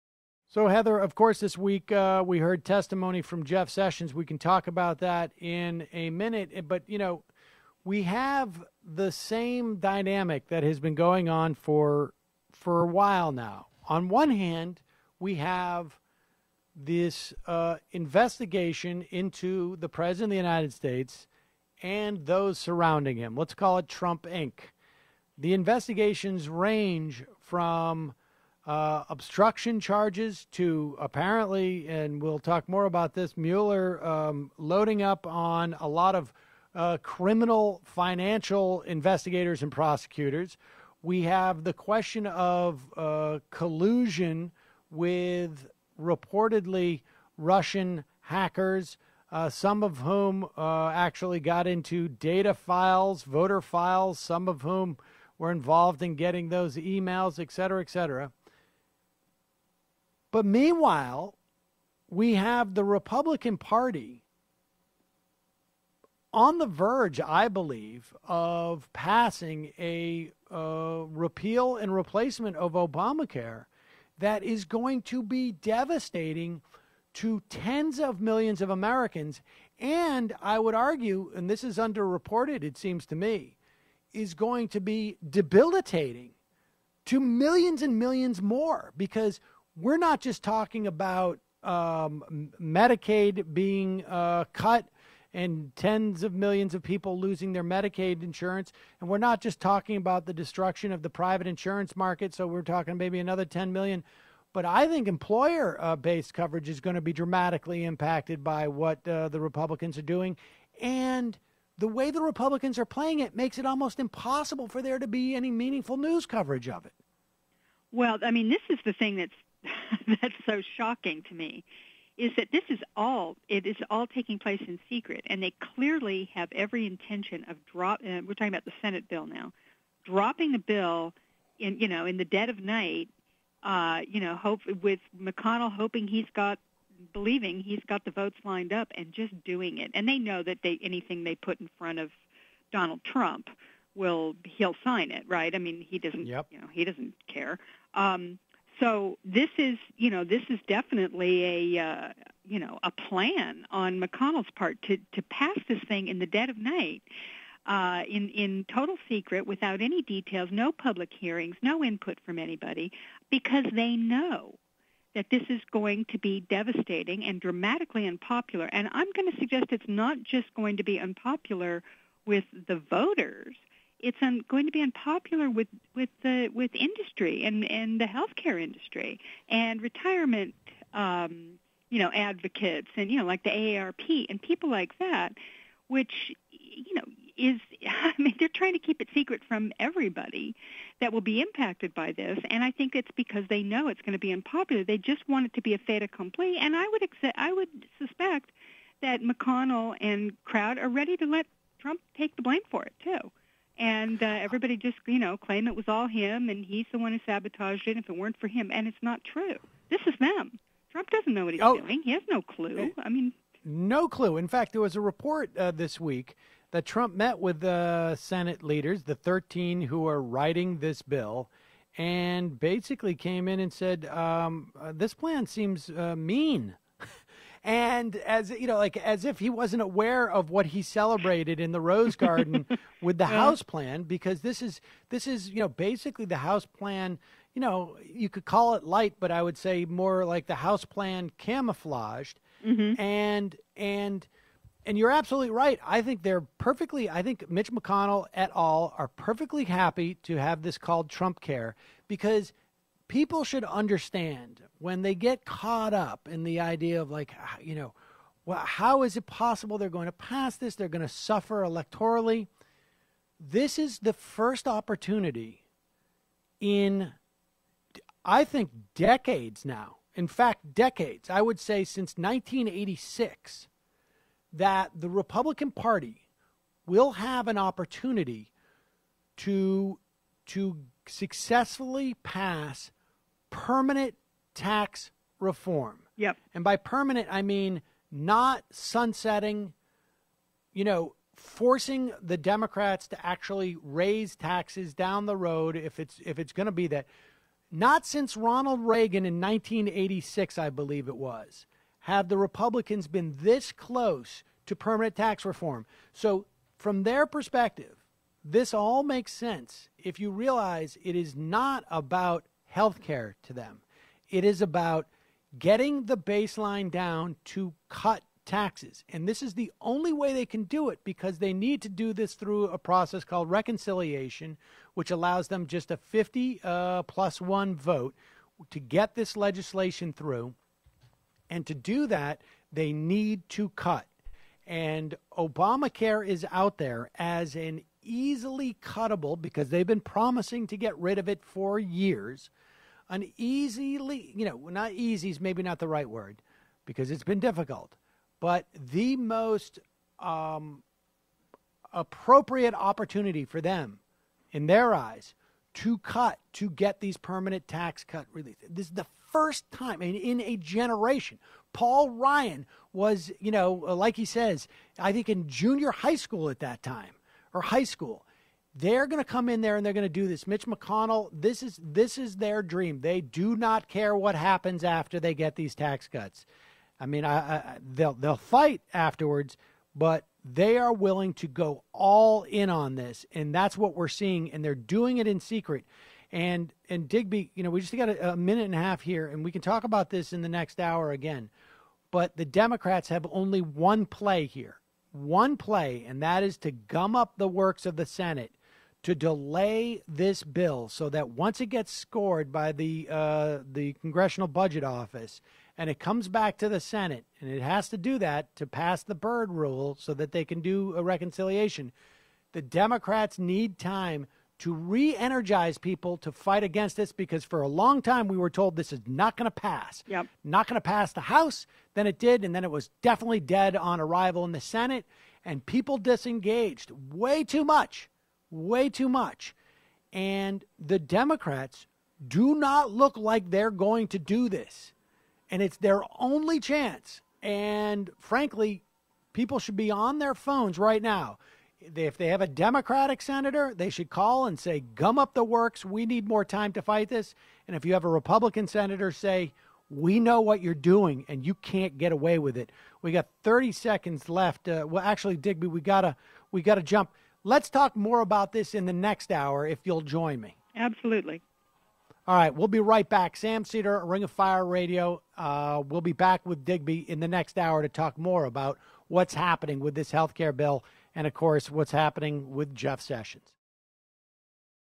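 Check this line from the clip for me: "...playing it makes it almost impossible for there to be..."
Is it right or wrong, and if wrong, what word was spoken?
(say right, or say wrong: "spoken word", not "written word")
right.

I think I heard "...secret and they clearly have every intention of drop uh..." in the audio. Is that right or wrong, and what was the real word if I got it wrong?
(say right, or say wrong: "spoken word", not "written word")
right.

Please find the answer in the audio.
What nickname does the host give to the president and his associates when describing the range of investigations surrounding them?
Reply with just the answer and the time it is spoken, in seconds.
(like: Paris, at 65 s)
Trump Inc., at 23 s.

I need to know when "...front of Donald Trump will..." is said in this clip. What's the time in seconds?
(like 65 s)
141 s.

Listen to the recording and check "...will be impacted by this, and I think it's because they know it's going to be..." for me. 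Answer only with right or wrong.
right.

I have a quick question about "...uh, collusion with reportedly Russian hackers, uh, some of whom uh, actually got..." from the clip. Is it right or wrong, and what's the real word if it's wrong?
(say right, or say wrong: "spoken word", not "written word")
right.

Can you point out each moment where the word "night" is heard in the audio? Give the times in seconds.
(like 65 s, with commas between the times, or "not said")
132 s, 156 s.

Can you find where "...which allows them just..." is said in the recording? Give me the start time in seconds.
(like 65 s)
324 s.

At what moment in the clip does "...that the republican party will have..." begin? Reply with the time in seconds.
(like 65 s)
274 s.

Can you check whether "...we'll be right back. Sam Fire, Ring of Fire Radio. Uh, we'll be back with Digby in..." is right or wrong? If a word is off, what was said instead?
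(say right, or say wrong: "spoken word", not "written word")
wrong: "Seder", not "Fire".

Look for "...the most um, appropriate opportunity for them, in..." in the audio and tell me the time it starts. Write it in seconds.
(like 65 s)
348 s.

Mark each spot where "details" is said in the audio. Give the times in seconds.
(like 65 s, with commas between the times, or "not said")
160 s.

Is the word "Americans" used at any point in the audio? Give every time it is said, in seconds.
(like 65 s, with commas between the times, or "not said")
78 s.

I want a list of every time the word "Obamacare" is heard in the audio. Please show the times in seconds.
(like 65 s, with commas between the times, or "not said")
72 s, 335 s.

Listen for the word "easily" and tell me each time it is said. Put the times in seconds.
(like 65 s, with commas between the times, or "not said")
338 s, 343 s.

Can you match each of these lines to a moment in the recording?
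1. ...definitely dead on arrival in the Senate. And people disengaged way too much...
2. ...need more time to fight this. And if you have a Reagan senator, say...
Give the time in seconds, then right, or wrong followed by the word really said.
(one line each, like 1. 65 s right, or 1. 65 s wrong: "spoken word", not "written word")
1. 423 s right
2. 446 s wrong: "Republican", not "Reagan".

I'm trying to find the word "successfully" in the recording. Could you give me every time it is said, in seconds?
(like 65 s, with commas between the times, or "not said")
281 s.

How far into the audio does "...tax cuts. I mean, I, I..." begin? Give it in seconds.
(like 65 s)
375 s.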